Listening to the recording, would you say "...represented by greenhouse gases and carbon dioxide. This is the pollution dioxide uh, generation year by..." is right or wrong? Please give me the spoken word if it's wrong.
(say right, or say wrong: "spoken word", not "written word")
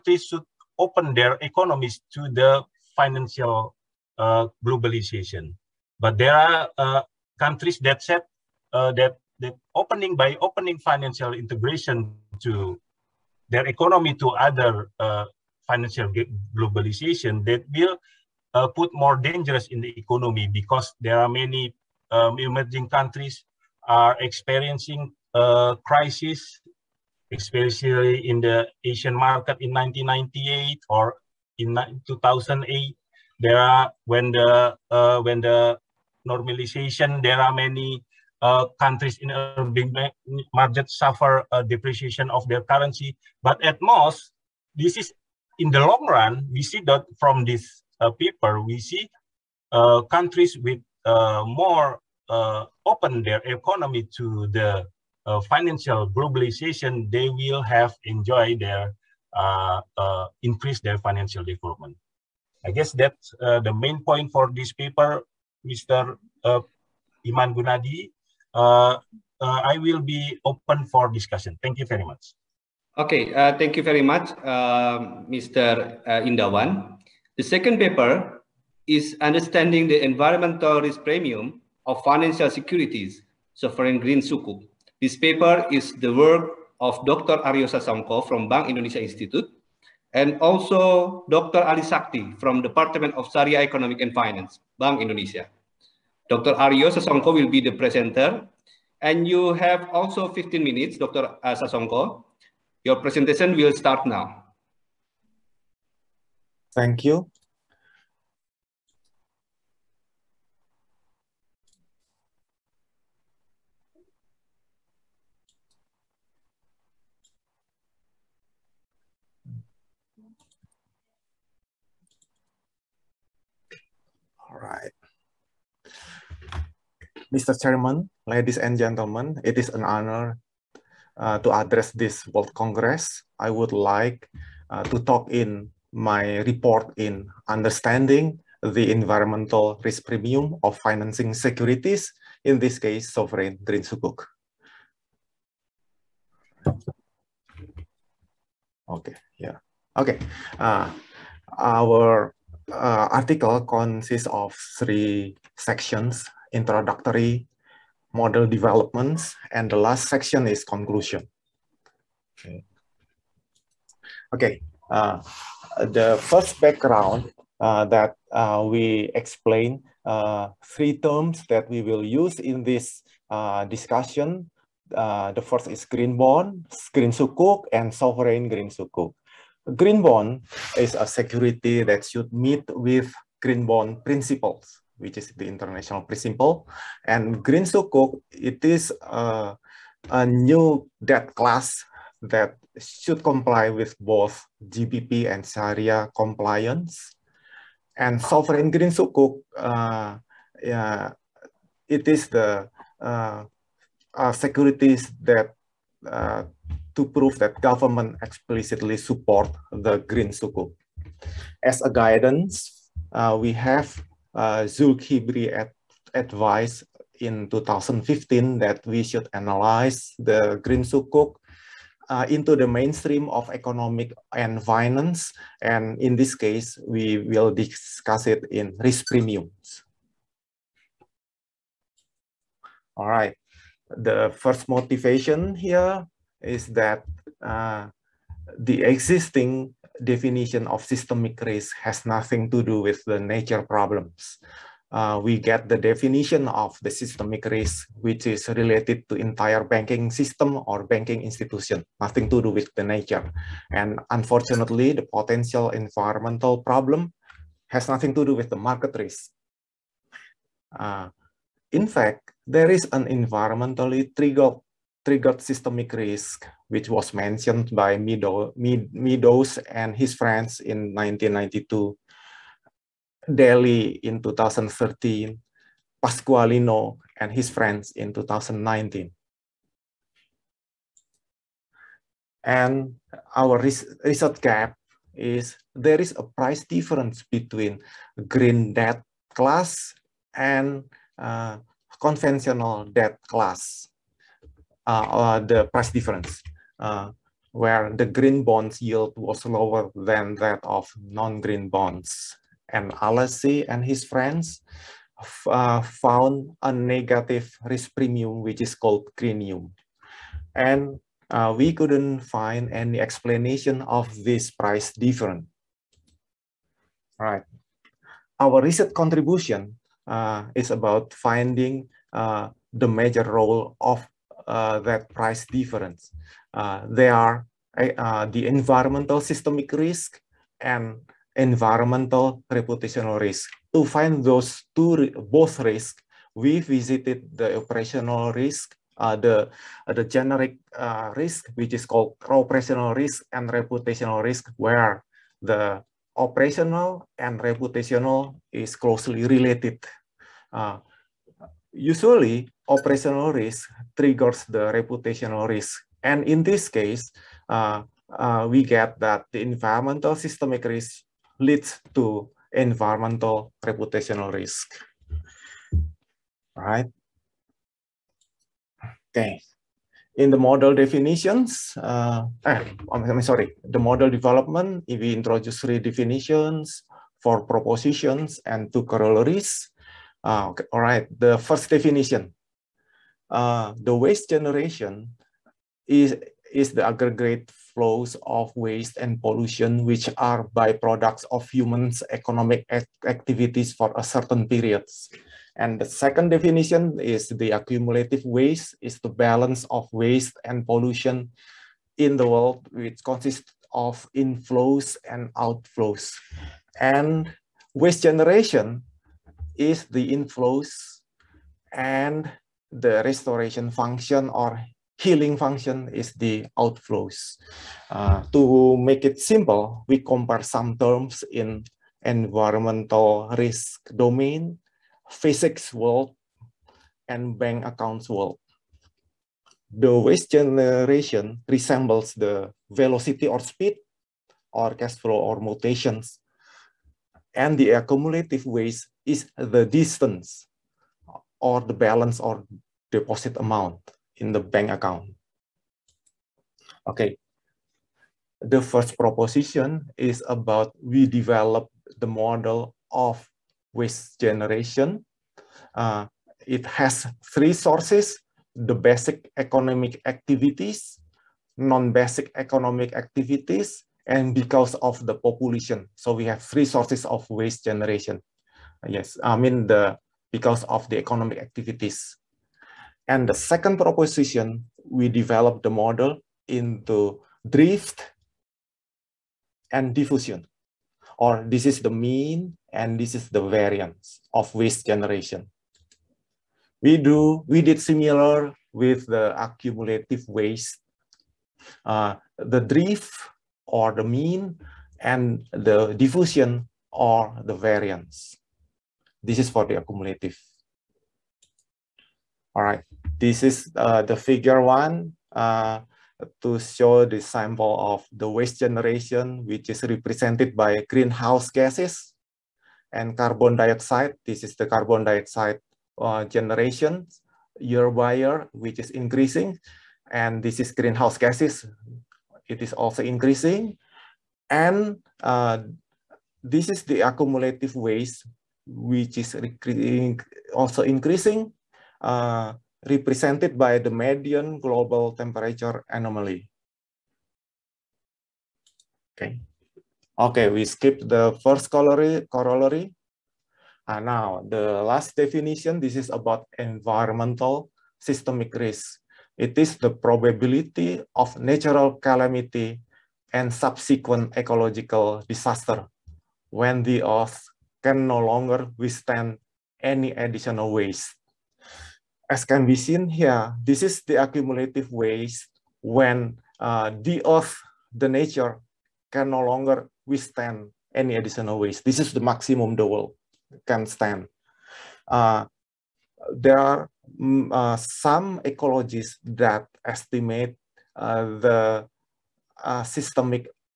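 wrong: "carbon", not "pollution".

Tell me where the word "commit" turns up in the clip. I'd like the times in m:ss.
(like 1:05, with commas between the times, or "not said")
not said.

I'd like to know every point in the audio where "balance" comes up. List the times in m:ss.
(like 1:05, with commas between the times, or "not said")
6:39, 7:21.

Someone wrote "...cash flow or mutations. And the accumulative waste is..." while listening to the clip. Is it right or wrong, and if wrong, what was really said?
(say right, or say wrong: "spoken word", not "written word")
right.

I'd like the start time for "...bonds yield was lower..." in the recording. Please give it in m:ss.
4:58.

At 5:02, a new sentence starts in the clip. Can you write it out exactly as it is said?
And Alessi and his friends uh, found a negative risk premium, which is called greenium.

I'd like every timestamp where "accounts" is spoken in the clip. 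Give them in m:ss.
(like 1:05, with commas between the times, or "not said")
7:07, 7:24.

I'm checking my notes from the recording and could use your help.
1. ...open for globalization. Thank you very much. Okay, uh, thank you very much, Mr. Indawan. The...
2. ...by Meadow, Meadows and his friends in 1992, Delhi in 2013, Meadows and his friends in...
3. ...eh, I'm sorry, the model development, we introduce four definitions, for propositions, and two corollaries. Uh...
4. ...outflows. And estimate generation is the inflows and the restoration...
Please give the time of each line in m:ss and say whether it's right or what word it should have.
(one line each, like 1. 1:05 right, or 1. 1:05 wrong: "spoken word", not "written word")
1. 1:10 wrong: "discussion", not "globalization"
2. 4:27 wrong: "Pasqualino", not "Meadows"
3. 6:12 wrong: "three", not "four"
4. 6:45 wrong: "waste", not "estimate".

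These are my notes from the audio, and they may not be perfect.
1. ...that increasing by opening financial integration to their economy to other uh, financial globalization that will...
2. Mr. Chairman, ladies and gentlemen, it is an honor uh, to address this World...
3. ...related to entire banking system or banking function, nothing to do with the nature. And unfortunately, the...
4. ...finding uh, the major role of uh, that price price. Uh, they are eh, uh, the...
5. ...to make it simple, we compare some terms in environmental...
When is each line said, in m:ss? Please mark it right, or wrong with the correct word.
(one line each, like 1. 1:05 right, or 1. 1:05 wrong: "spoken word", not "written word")
1. 0:09 wrong: "opening", not "increasing"
2. 2:07 right
3. 4:08 wrong: "institution", not "function"
4. 5:21 wrong: "difference", not "price"
5. 6:58 right.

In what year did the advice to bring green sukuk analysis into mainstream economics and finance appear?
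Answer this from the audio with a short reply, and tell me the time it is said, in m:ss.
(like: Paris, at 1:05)
2015, at 3:37.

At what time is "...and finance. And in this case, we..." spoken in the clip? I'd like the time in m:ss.
3:44.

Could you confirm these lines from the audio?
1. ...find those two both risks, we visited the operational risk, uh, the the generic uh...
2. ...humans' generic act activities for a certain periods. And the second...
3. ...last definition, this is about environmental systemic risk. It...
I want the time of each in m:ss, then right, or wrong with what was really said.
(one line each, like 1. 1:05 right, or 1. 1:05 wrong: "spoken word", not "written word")
1. 5:33 right
2. 6:31 wrong: "economic", not "generic"
3. 9:04 right.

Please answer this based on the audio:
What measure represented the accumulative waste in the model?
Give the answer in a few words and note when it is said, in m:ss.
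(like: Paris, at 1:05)
Median global temperature anomaly, at 8:53.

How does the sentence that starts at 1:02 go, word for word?
I guess that's the main point for this paper, Mr.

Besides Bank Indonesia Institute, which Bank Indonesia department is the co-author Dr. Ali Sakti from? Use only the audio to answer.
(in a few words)
Department of Sharia Economic and Finance.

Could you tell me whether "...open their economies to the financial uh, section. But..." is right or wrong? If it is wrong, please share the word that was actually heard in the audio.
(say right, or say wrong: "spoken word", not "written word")
wrong: "globalization", not "section".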